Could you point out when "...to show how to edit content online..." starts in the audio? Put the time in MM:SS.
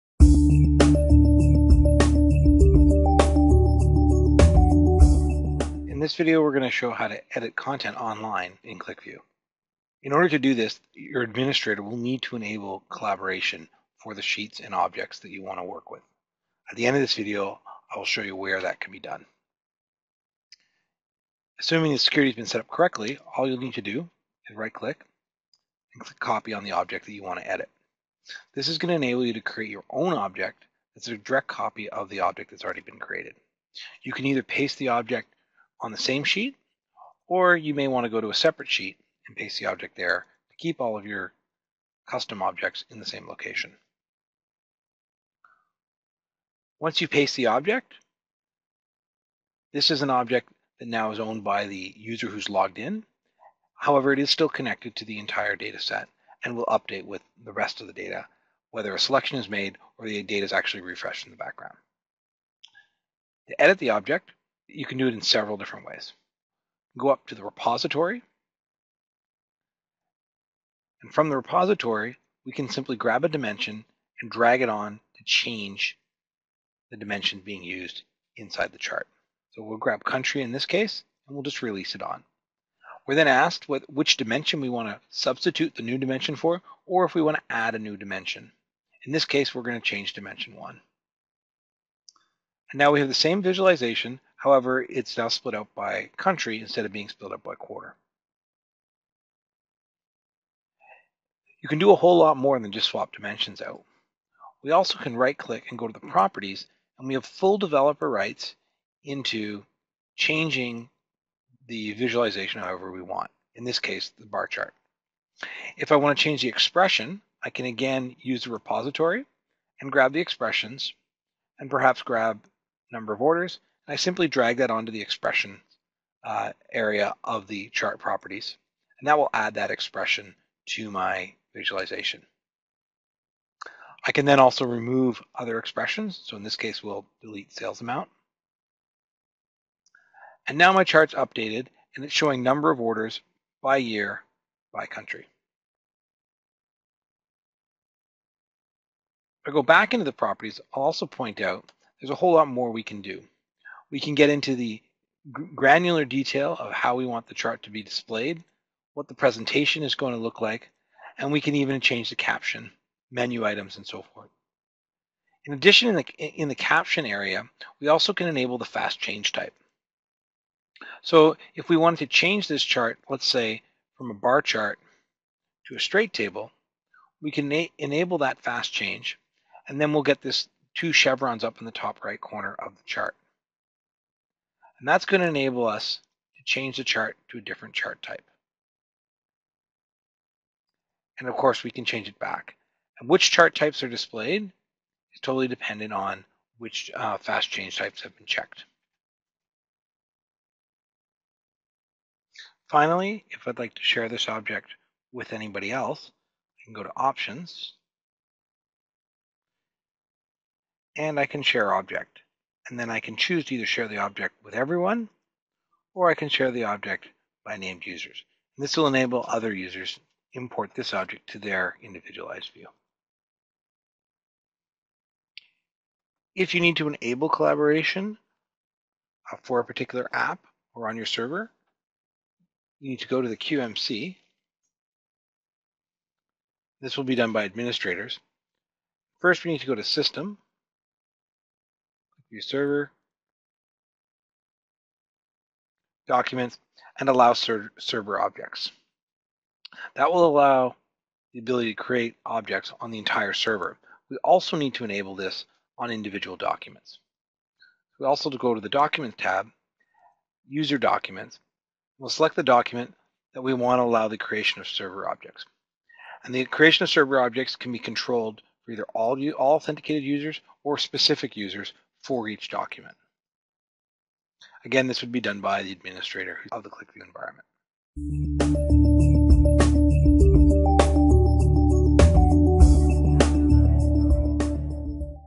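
00:06.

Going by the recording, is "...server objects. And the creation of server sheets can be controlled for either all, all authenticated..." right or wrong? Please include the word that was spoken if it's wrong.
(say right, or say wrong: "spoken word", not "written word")
wrong: "objects", not "sheets".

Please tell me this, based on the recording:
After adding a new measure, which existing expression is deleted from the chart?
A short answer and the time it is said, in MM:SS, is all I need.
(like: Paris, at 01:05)
sales amount, at 02:17.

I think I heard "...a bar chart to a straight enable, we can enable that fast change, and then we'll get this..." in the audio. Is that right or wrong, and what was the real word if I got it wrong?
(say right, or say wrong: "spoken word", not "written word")
wrong: "table", not "enable".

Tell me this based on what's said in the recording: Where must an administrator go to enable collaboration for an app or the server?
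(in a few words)
the QMC.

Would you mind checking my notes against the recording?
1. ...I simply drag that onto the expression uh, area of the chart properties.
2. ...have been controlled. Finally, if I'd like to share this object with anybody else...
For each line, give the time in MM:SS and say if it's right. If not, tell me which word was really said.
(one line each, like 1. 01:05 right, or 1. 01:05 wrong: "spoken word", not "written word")
1. 02:03 right
2. 03:18 wrong: "checked", not "controlled".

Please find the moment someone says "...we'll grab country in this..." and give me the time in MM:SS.
01:19.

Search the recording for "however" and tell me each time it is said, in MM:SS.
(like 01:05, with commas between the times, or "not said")
00:53, 01:34, 01:52.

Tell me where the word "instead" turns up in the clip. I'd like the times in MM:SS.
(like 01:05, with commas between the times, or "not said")
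01:36.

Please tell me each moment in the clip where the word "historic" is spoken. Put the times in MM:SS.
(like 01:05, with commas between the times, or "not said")
not said.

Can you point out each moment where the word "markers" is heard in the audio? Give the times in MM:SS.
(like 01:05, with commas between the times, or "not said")
not said.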